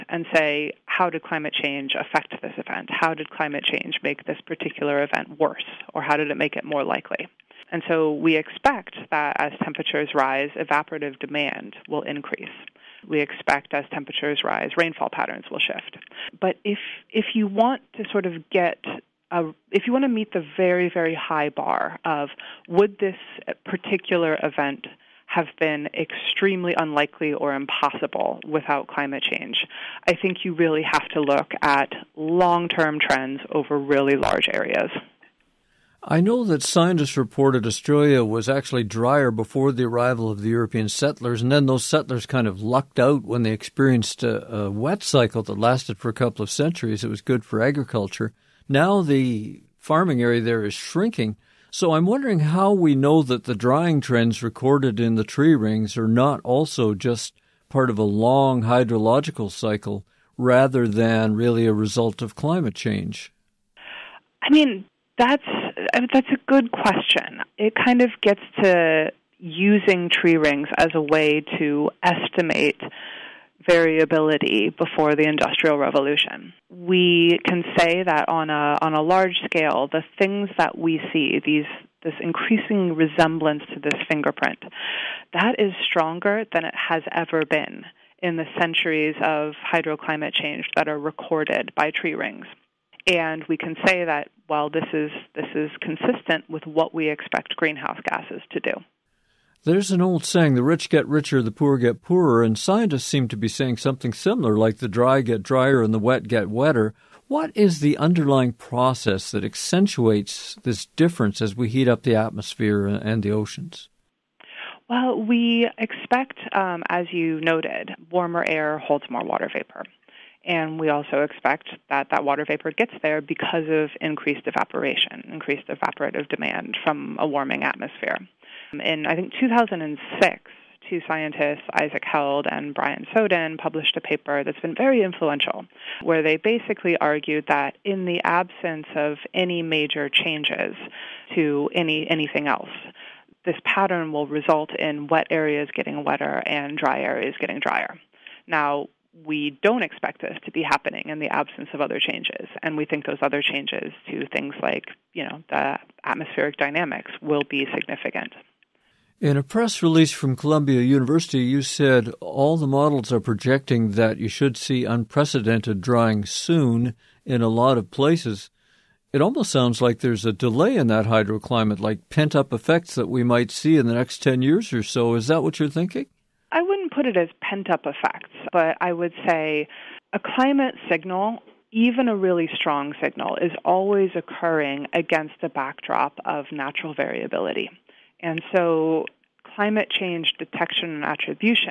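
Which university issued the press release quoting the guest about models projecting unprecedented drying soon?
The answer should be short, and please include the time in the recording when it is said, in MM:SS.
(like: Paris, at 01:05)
Columbia University, at 02:40.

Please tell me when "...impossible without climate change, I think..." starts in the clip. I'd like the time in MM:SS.
00:27.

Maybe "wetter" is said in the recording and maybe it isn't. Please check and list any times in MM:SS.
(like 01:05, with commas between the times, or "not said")
01:46, 02:26.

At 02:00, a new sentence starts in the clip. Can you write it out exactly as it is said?
And we also expect that that water vapor gets there because of increased evaporation, increased evaporative demand from a warming atmosphere.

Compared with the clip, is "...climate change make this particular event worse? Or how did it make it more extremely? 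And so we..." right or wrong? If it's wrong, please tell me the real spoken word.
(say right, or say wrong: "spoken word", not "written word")
wrong: "likely", not "extremely".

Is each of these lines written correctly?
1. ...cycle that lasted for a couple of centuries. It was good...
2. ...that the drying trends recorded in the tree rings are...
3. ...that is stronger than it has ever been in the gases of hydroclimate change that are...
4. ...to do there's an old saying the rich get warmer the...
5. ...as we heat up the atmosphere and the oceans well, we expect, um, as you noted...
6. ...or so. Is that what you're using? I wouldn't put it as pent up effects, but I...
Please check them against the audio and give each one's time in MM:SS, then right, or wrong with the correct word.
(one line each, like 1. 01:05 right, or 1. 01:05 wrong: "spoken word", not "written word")
1. 00:45 right
2. 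00:53 right
3. 01:25 wrong: "centuries", not "gases"
4. 01:38 wrong: "richer", not "warmer"
5. 01:51 right
6. 02:54 wrong: "thinking", not "using".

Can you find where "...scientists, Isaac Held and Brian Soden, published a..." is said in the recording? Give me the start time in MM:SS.
02:11.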